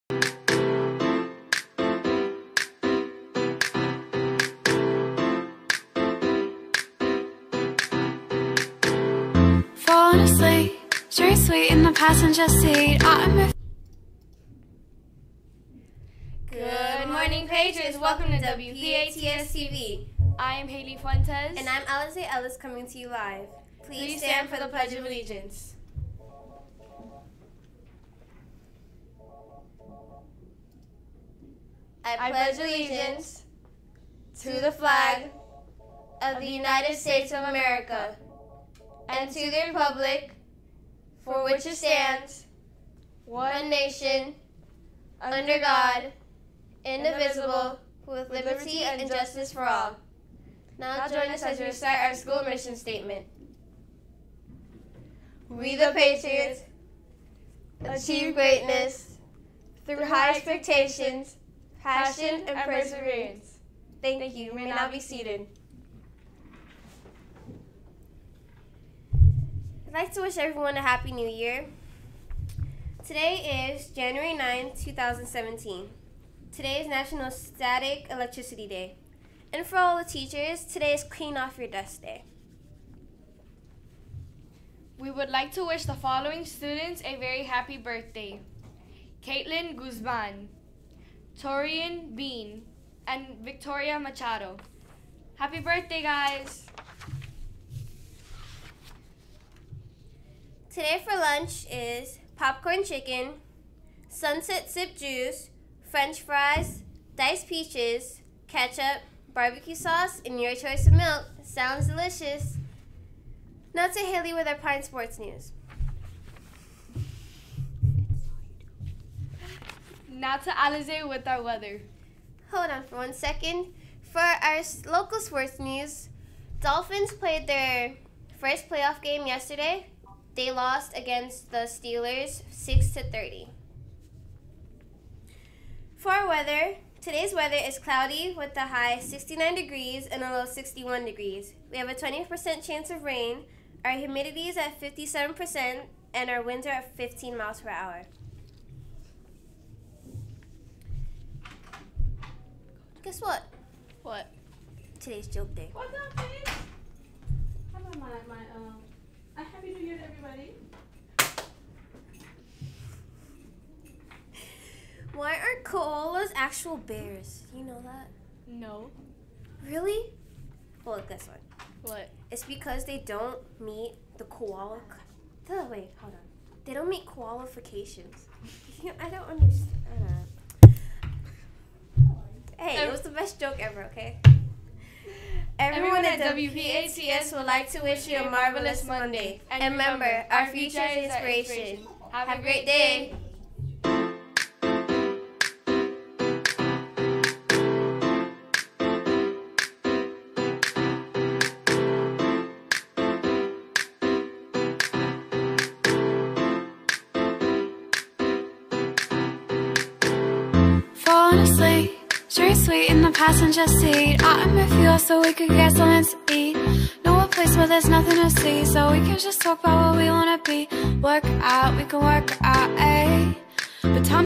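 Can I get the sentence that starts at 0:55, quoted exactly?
We the Patriots achieve greatness through high expectations, passion, and perseverance.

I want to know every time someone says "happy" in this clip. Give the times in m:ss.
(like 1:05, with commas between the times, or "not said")
1:10, 1:27, 1:35, 2:39.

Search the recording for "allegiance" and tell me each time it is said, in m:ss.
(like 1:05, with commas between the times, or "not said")
0:25, 0:32.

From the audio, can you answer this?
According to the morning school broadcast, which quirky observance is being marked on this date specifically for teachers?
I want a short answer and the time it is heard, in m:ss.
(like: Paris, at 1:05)
Clean Off Your Desk Day, at 1:21.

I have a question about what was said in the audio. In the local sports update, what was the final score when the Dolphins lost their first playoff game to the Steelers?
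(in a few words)
6 to 30.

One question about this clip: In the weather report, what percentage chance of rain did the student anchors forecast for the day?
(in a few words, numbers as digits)
20%.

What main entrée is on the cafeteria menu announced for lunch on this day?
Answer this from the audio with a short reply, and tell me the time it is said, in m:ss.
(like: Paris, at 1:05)
Popcorn chicken, at 1:42.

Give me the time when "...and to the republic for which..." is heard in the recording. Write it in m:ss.
0:39.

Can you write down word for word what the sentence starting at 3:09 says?
And remember, our future is inspiration.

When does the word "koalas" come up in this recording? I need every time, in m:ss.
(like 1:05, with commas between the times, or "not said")
2:45, 2:54.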